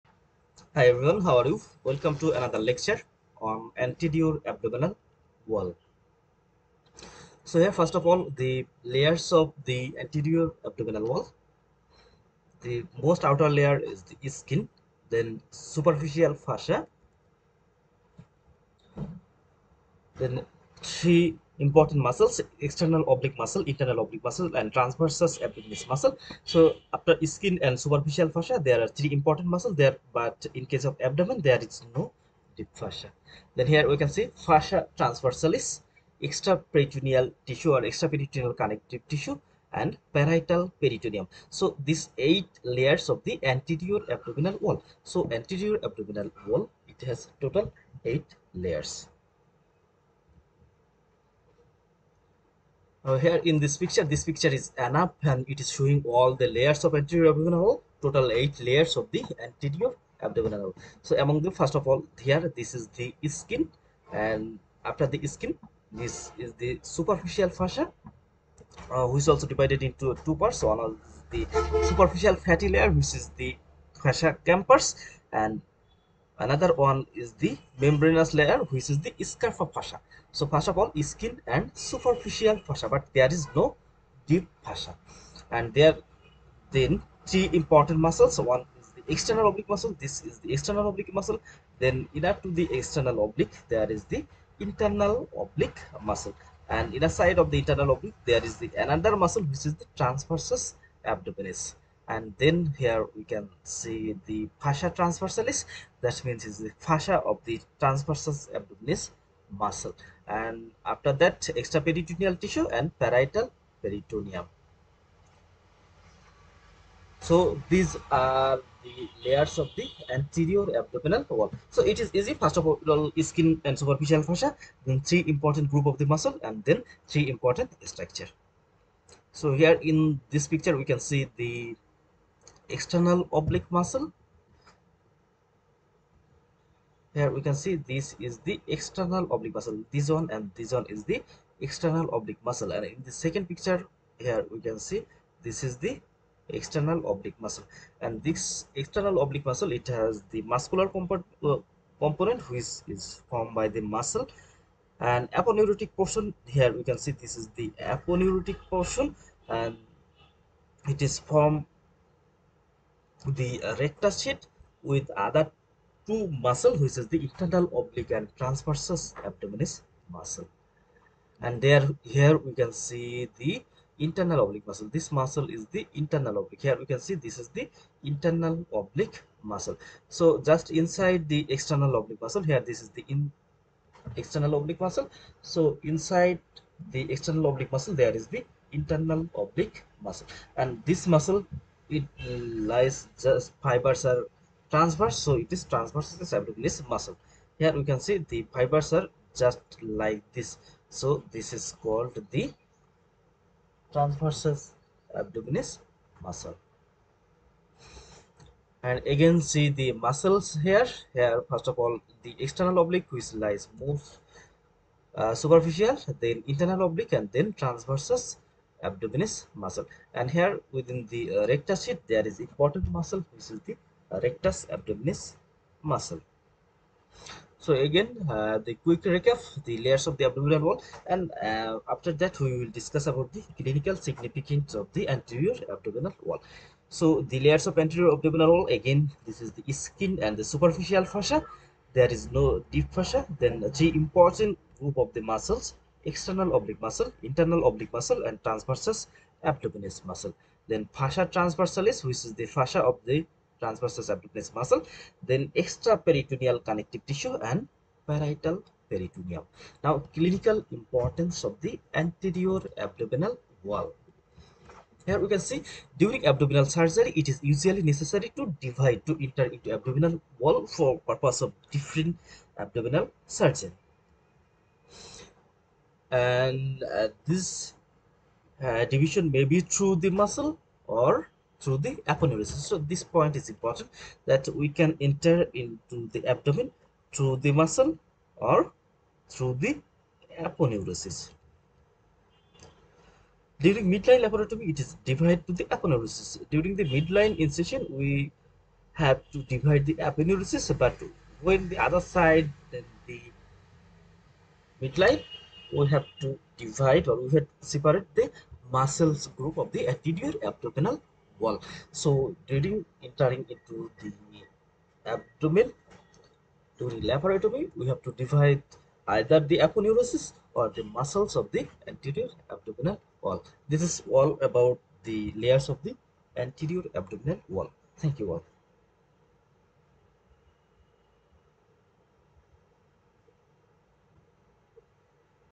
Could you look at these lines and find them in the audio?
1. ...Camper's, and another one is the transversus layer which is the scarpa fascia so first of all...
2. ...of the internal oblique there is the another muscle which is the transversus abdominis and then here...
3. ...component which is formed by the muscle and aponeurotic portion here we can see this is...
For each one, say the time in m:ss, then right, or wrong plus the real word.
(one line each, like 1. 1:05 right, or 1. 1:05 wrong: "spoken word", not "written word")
1. 1:14 wrong: "membranous", not "transversus"
2. 1:37 right
3. 2:31 right.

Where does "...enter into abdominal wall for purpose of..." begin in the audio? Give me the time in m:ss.
4:29.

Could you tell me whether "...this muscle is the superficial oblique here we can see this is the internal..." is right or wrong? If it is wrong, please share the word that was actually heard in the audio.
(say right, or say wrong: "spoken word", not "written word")
wrong: "internal", not "superficial".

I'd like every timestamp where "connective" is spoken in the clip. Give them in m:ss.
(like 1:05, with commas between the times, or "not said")
0:38, 4:16.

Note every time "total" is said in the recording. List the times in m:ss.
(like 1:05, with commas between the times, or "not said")
0:47, 0:58.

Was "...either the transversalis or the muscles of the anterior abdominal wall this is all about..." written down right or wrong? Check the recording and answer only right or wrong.
wrong.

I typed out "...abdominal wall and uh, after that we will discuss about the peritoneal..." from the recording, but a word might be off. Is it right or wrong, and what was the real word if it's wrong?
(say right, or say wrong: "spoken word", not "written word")
wrong: "clinical", not "peritoneal".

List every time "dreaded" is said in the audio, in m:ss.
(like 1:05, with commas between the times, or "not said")
not said.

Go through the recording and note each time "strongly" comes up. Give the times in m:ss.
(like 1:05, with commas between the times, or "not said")
not said.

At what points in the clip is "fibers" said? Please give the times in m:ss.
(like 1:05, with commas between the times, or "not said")
3:13, 3:18.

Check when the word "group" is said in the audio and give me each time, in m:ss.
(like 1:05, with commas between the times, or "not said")
2:05, 4:04, 5:09.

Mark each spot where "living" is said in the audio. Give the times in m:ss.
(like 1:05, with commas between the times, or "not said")
not said.